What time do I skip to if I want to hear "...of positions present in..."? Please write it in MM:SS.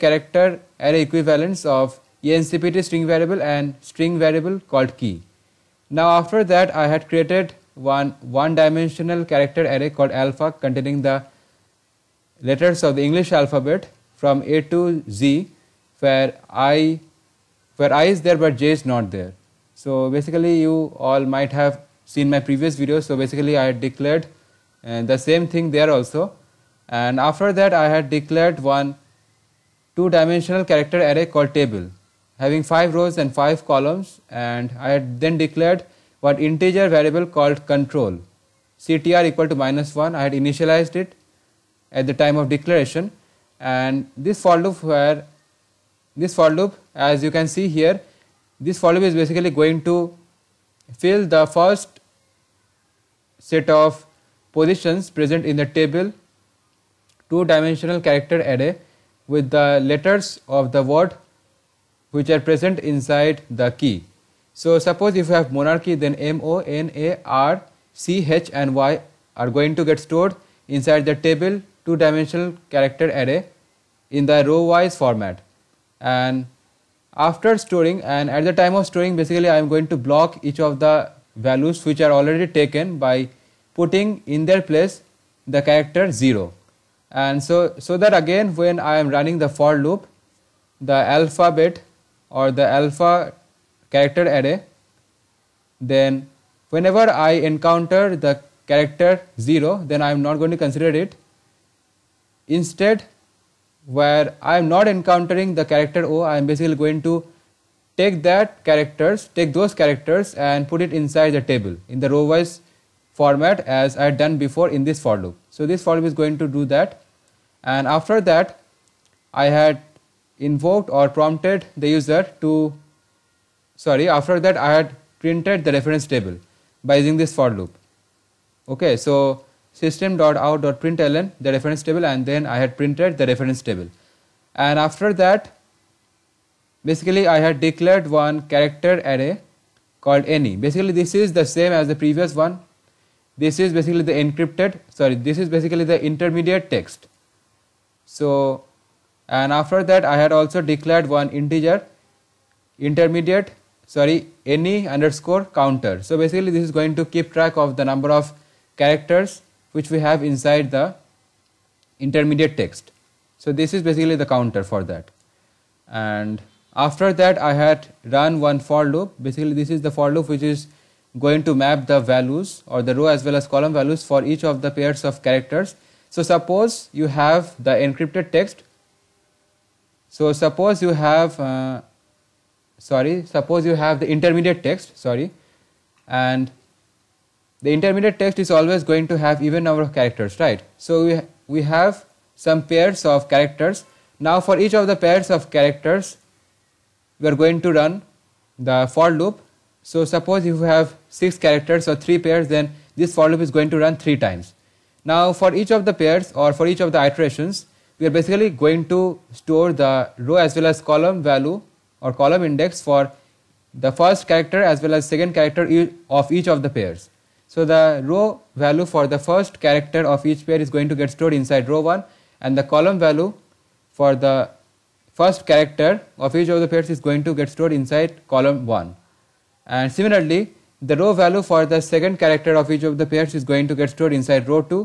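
00:53.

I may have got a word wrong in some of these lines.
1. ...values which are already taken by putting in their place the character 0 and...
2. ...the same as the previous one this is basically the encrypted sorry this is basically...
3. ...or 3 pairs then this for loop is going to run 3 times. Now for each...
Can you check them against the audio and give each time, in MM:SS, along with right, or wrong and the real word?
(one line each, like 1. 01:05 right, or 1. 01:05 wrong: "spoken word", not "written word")
1. 01:21 right
2. 02:21 right
3. 03:21 right.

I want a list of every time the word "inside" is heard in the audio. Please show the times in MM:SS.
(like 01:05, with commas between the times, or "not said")
01:02, 01:10, 01:50, 02:40, 03:41, 03:47, 03:54.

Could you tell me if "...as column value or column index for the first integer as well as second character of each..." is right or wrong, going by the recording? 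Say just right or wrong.
wrong.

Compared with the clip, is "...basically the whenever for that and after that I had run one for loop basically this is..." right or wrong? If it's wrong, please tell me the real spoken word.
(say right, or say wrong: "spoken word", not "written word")
wrong: "counter", not "whenever".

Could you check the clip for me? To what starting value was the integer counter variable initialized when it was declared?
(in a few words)
-1.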